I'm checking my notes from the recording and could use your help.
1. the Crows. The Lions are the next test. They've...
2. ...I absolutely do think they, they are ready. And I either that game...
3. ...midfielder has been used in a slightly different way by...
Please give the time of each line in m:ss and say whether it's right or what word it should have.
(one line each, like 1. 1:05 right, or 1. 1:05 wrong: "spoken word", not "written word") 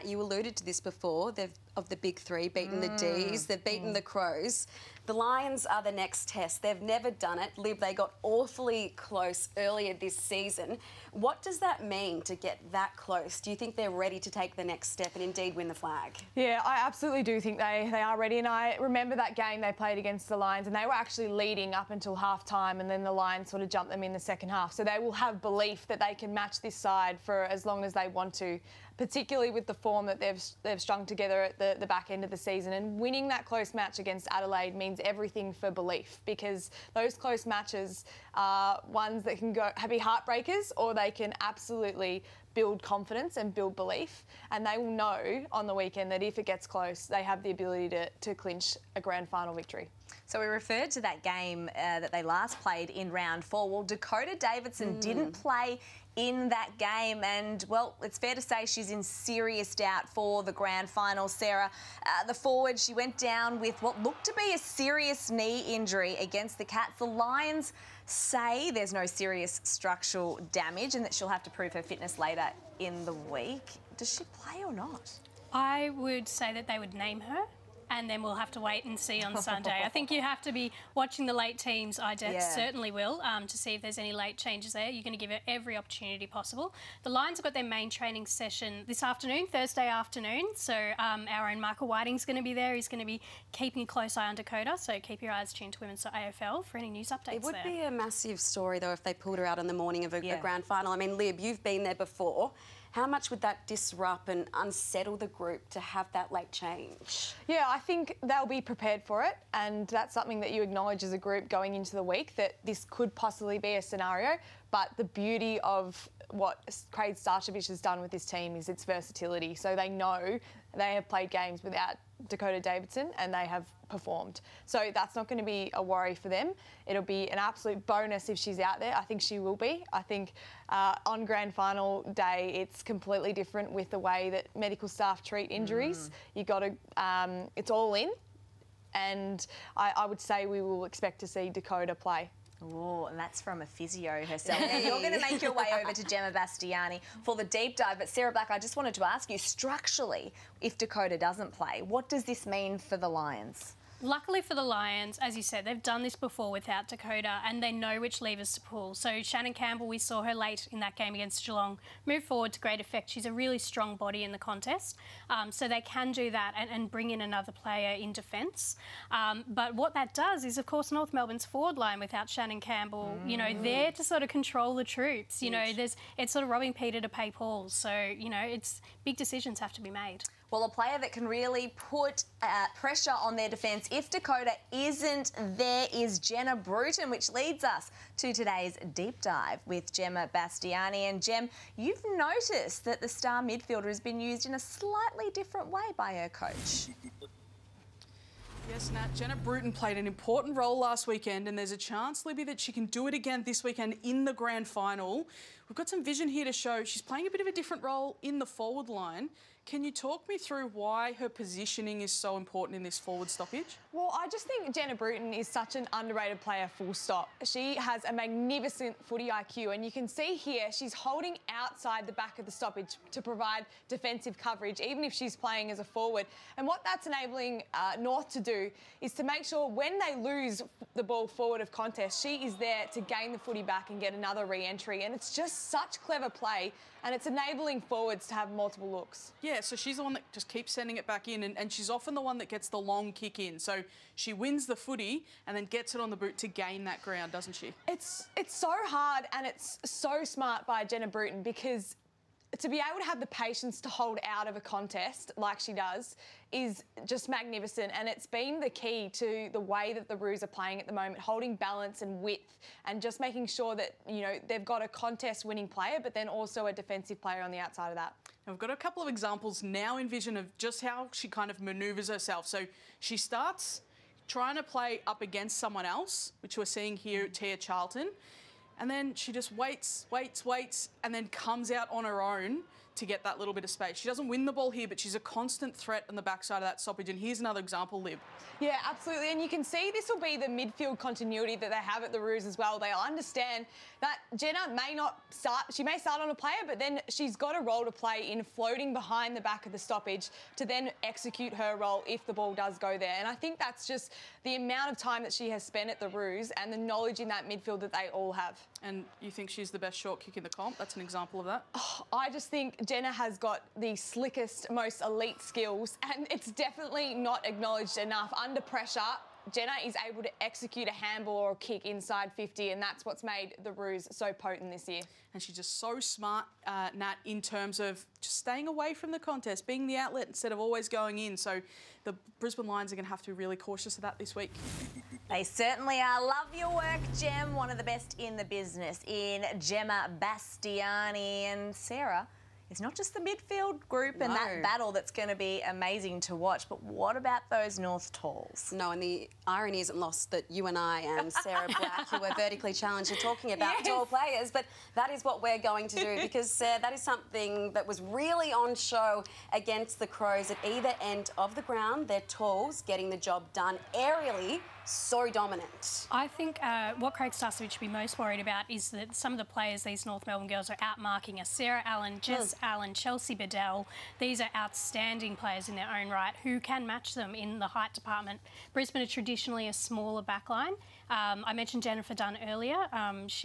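1. 0:03 right
2. 0:16 wrong: "remember", not "either"
3. 3:13 right.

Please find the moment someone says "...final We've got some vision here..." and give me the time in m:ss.
3:24.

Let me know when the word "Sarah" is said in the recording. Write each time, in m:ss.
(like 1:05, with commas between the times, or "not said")
1:01, 2:28, 5:41, 5:51, 6:11.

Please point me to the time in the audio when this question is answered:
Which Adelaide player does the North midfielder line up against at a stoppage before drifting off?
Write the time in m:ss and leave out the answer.
4:37.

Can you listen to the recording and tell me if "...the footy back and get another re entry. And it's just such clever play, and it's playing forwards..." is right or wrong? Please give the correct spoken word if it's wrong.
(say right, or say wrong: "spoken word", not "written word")
wrong: "enabling", not "playing".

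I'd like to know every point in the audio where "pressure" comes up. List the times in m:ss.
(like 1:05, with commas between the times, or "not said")
3:02, 5:18.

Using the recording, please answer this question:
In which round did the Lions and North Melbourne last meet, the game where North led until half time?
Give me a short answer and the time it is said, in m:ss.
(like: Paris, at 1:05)
Round 4, at 0:53.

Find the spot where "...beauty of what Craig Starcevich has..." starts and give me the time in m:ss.
1:55.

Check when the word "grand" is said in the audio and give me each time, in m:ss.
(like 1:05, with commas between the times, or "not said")
0:49, 1:00, 1:40, 2:11, 3:24.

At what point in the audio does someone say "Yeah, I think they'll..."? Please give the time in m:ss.
1:47.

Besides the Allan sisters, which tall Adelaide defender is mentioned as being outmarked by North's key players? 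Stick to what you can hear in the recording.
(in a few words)
Chelsea Biddell.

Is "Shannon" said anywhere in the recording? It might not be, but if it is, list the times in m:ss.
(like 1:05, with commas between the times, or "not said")
2:39, 2:52.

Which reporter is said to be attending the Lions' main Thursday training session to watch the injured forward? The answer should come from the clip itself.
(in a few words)
Michael Whiting.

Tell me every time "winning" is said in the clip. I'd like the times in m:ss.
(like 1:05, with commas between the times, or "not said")
0:32, 4:25.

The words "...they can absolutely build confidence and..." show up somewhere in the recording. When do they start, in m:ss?
0:40.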